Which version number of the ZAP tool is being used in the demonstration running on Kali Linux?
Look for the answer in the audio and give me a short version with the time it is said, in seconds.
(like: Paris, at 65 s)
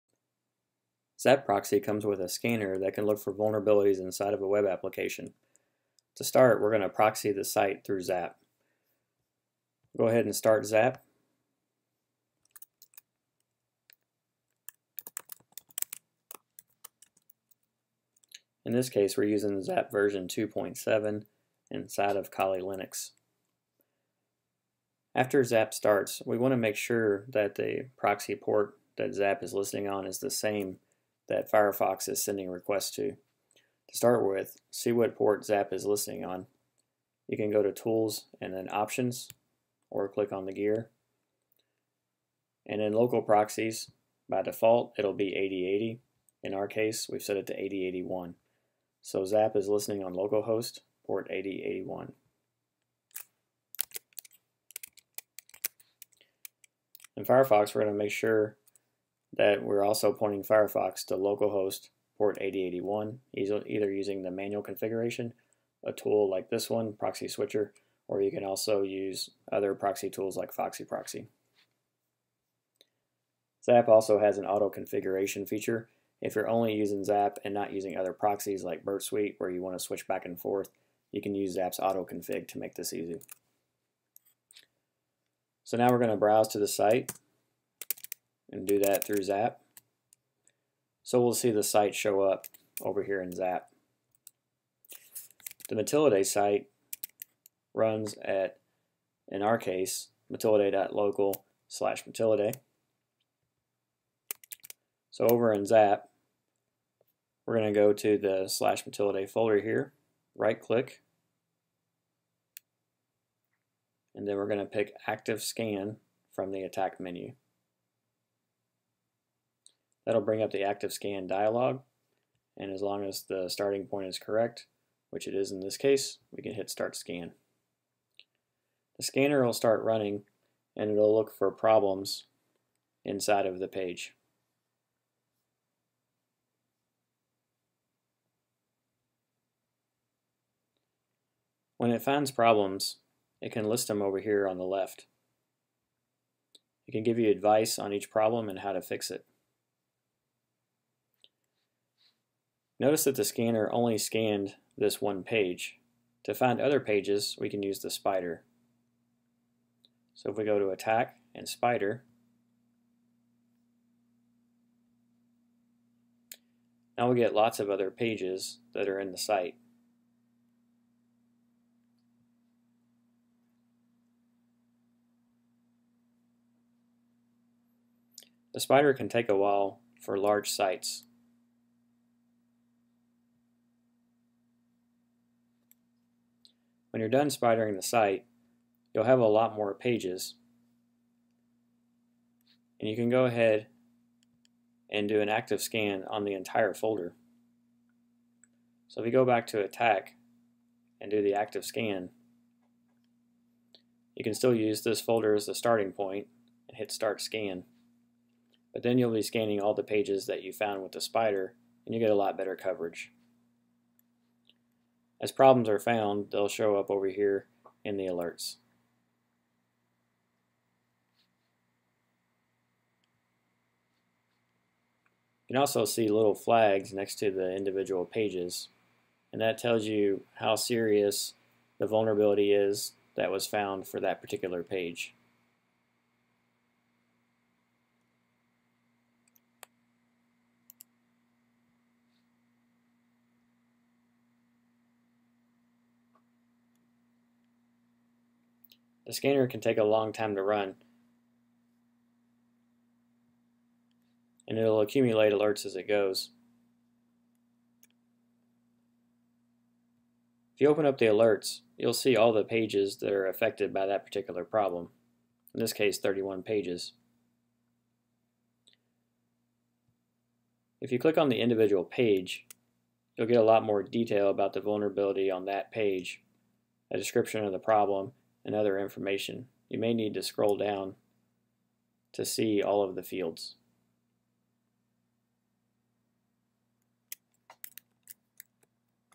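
2.7, at 20 s.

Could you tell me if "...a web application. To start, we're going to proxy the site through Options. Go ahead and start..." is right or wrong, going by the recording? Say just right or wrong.
wrong.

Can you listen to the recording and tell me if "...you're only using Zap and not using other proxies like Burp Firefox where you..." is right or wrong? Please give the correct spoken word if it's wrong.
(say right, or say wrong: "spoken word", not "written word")
wrong: "Suite", not "Firefox".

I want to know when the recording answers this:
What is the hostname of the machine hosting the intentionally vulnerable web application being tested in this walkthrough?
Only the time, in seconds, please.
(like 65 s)
100 s.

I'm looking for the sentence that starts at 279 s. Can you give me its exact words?
You may need to scroll down to see all of the fields.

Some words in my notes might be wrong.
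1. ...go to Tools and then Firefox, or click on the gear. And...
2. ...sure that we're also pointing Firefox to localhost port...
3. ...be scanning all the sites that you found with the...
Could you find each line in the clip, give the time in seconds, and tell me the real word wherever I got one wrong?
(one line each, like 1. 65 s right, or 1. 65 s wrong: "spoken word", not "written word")
1. 37 s wrong: "Options", not "Firefox"
2. 58 s right
3. 209 s wrong: "pages", not "sites".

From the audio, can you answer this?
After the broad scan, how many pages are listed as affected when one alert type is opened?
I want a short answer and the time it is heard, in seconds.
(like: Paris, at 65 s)
31, at 265 s.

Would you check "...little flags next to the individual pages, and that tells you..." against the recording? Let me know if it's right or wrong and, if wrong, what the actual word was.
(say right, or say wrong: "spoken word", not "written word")
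right.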